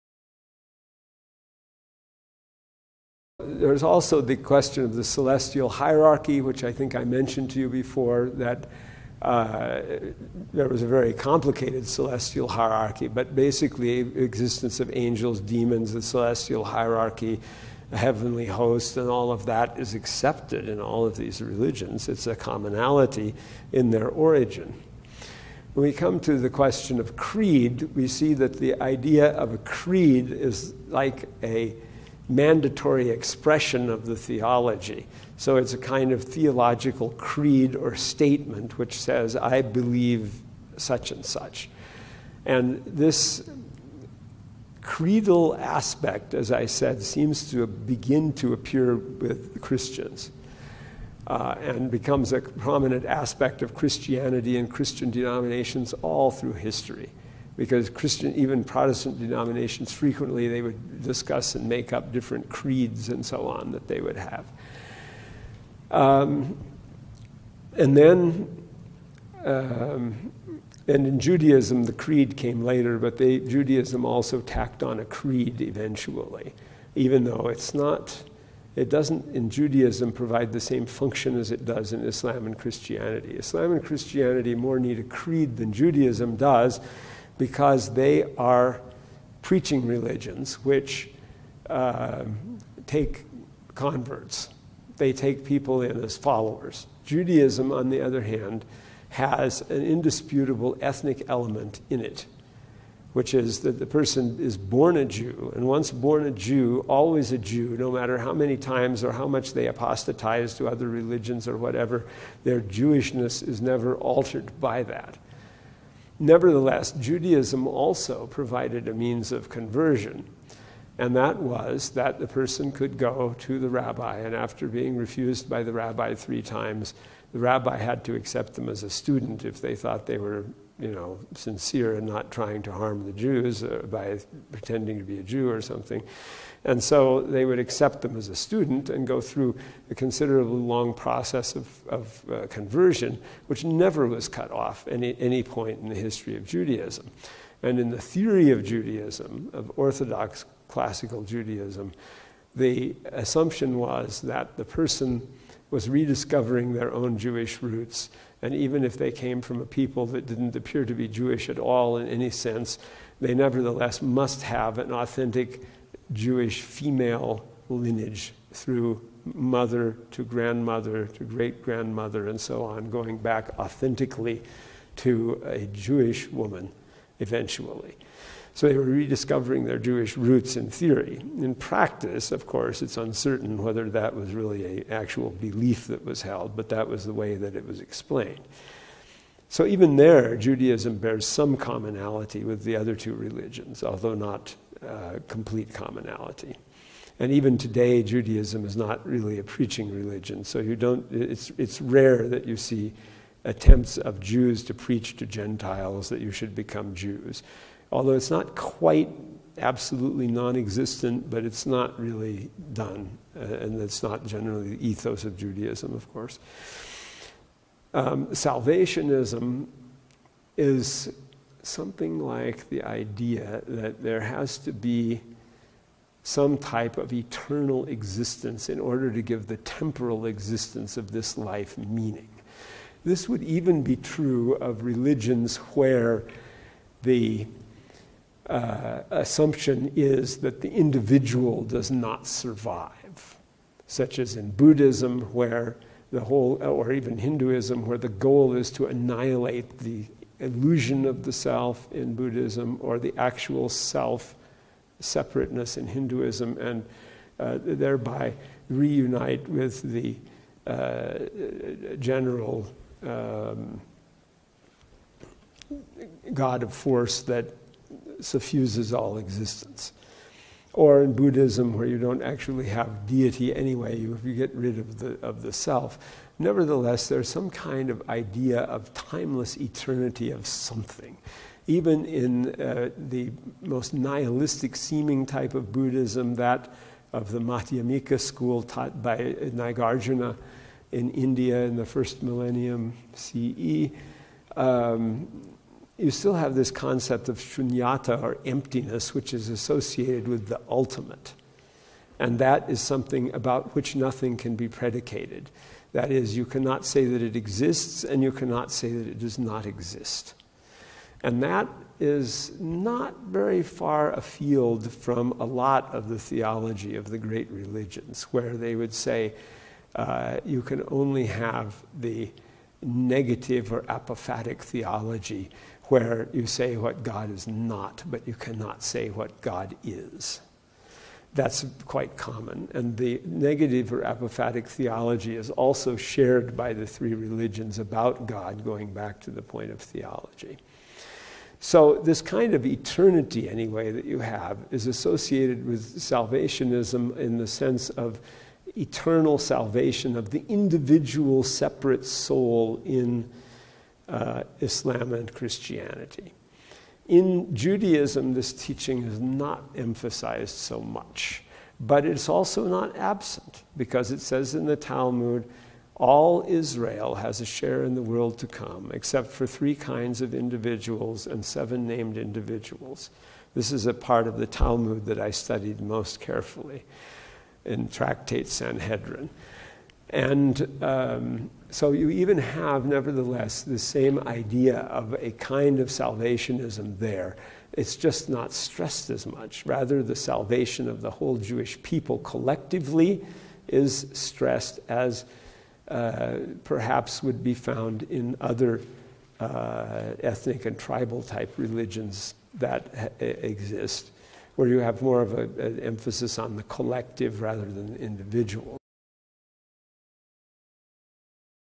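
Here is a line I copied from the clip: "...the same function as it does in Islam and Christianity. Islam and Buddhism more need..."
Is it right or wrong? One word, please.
wrong.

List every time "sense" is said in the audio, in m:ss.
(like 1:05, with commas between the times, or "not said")
2:42, 5:47.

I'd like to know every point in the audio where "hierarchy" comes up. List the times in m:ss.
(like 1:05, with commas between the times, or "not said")
0:05, 0:12, 0:16.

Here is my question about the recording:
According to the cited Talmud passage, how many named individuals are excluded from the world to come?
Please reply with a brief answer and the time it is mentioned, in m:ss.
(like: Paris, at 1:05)
7, at 6:11.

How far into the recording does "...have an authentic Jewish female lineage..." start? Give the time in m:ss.
2:44.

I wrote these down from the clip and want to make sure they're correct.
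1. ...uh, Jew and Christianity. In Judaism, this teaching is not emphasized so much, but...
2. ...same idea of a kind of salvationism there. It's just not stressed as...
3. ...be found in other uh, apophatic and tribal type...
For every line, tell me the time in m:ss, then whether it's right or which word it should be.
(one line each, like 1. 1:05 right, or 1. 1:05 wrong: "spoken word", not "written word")
1. 5:54 wrong: "Islam", not "Jew"
2. 6:23 right
3. 6:37 wrong: "ethnic", not "apophatic".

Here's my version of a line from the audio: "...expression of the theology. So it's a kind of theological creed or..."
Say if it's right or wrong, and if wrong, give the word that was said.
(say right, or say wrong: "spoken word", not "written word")
right.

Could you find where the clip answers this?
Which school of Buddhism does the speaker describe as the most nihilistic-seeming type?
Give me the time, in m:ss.
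4:47.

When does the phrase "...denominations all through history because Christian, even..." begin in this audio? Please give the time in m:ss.
0:55.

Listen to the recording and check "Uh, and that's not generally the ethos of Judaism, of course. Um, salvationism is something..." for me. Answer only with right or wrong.
right.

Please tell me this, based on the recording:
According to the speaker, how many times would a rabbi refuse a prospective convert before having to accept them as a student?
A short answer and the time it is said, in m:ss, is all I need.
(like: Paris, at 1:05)
3, at 2:06.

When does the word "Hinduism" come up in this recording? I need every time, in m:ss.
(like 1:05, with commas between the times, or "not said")
4:07, 4:15.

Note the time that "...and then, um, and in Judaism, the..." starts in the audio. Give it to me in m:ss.
1:07.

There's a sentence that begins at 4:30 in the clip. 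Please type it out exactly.
Or in Buddhism, where you don't actually have deity anyway, you, you get rid of the, of the self.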